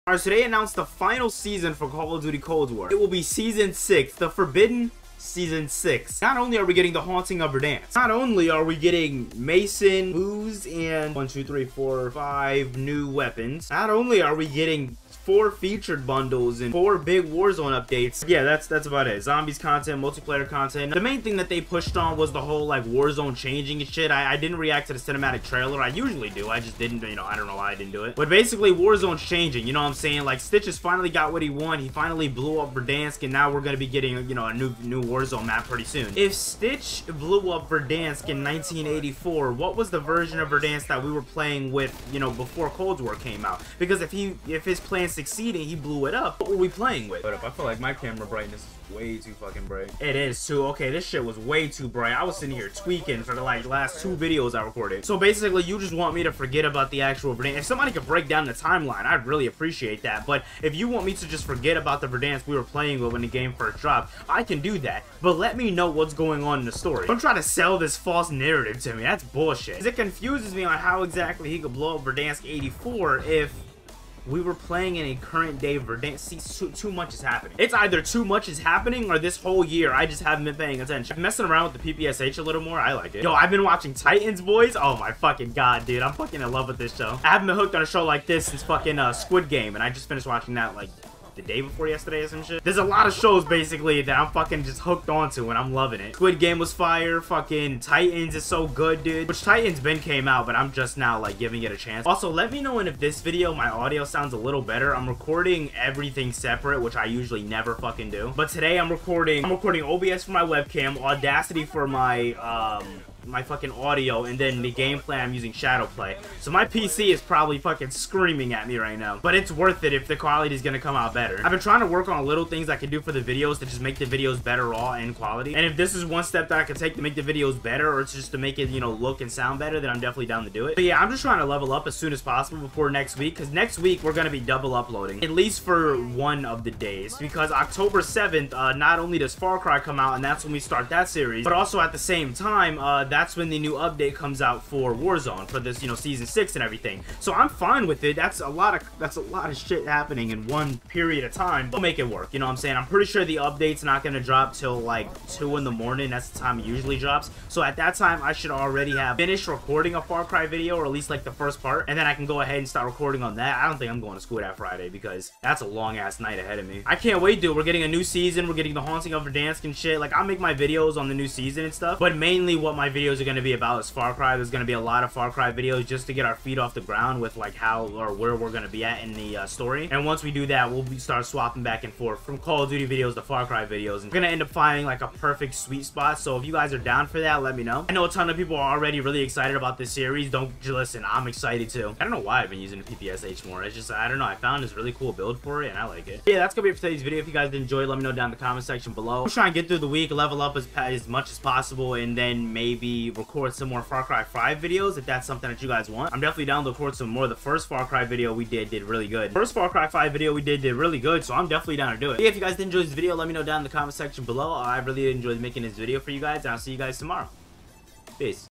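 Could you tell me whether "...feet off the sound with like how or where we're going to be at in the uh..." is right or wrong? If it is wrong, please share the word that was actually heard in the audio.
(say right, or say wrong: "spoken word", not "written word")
wrong: "ground", not "sound".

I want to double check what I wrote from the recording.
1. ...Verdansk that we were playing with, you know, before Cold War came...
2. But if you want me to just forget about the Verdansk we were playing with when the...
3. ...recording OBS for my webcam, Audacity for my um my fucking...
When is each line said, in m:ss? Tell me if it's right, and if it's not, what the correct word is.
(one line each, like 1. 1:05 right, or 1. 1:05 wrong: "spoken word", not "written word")
1. 0:40 right
2. 1:00 right
3. 1:49 right.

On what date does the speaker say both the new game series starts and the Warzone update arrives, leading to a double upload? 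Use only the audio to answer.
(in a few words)
October 7.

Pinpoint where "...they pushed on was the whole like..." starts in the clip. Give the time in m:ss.
0:21.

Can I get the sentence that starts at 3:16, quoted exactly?
yeah, that's going to be it for today's video.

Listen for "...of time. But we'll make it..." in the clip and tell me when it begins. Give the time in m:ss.
2:31.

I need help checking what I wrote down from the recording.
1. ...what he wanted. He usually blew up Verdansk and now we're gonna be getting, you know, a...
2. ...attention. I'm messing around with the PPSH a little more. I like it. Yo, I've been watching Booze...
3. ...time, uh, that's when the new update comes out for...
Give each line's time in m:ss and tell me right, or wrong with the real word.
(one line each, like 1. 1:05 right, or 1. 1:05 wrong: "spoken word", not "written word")
1. 0:31 wrong: "finally", not "usually"
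2. 1:20 wrong: "Titans", not "Booze"
3. 2:22 right.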